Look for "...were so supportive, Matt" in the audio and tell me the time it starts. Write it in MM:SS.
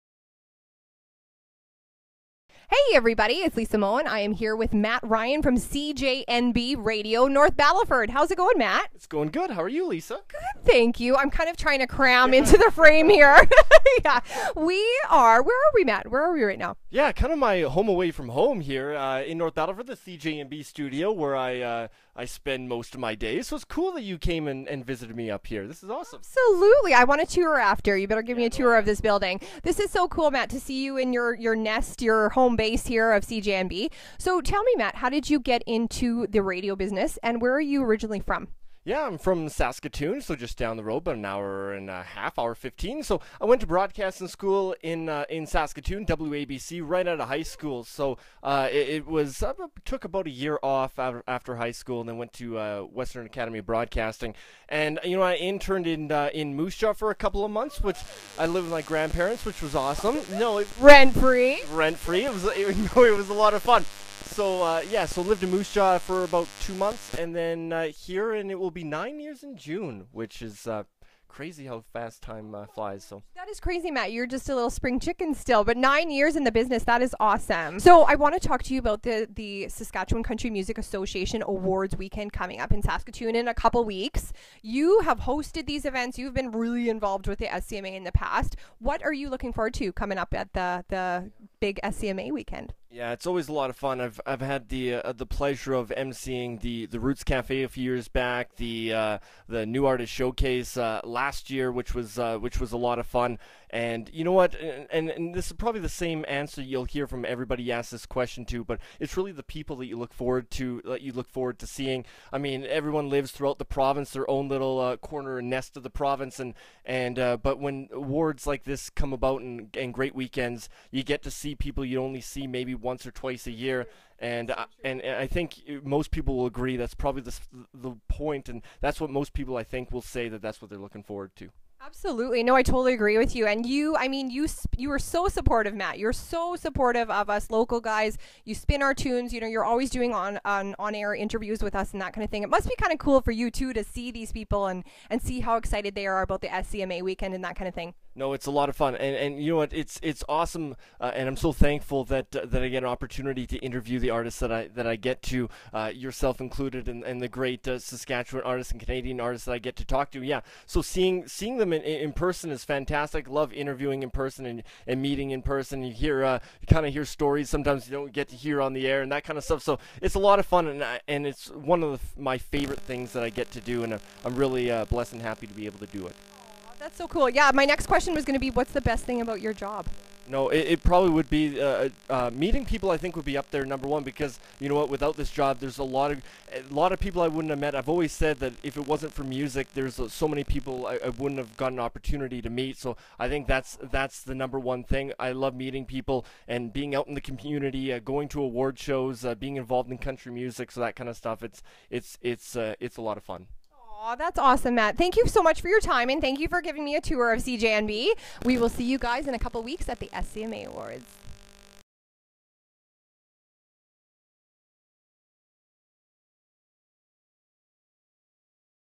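02:14.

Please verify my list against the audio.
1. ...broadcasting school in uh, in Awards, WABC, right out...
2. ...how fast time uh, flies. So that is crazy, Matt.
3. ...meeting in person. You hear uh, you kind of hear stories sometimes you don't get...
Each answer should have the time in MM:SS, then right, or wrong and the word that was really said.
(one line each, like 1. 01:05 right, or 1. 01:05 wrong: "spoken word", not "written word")
1. 00:43 wrong: "Saskatoon", not "Awards"
2. 01:11 right
3. 02:45 right.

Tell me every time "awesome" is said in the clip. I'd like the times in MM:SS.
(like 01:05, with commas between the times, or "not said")
00:25, 00:59, 01:17, 02:30, 03:24.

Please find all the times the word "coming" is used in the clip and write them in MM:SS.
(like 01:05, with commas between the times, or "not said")
01:22, 01:29.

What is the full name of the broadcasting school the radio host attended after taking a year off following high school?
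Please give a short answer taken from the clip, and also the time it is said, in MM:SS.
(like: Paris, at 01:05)
Western Academy of Broadcasting, at 00:52.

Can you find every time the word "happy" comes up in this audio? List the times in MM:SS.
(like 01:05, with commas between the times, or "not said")
02:55.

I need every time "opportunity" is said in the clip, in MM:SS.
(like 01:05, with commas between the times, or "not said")
02:32, 03:11.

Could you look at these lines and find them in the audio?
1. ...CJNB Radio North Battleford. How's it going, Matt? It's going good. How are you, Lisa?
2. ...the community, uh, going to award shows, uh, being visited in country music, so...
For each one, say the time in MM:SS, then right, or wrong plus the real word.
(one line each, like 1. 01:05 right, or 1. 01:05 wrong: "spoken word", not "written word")
1. 00:05 right
2. 03:17 wrong: "involved", not "visited".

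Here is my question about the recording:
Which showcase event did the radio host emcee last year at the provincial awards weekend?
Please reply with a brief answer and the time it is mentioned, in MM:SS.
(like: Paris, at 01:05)
New Artist Showcase, at 01:39.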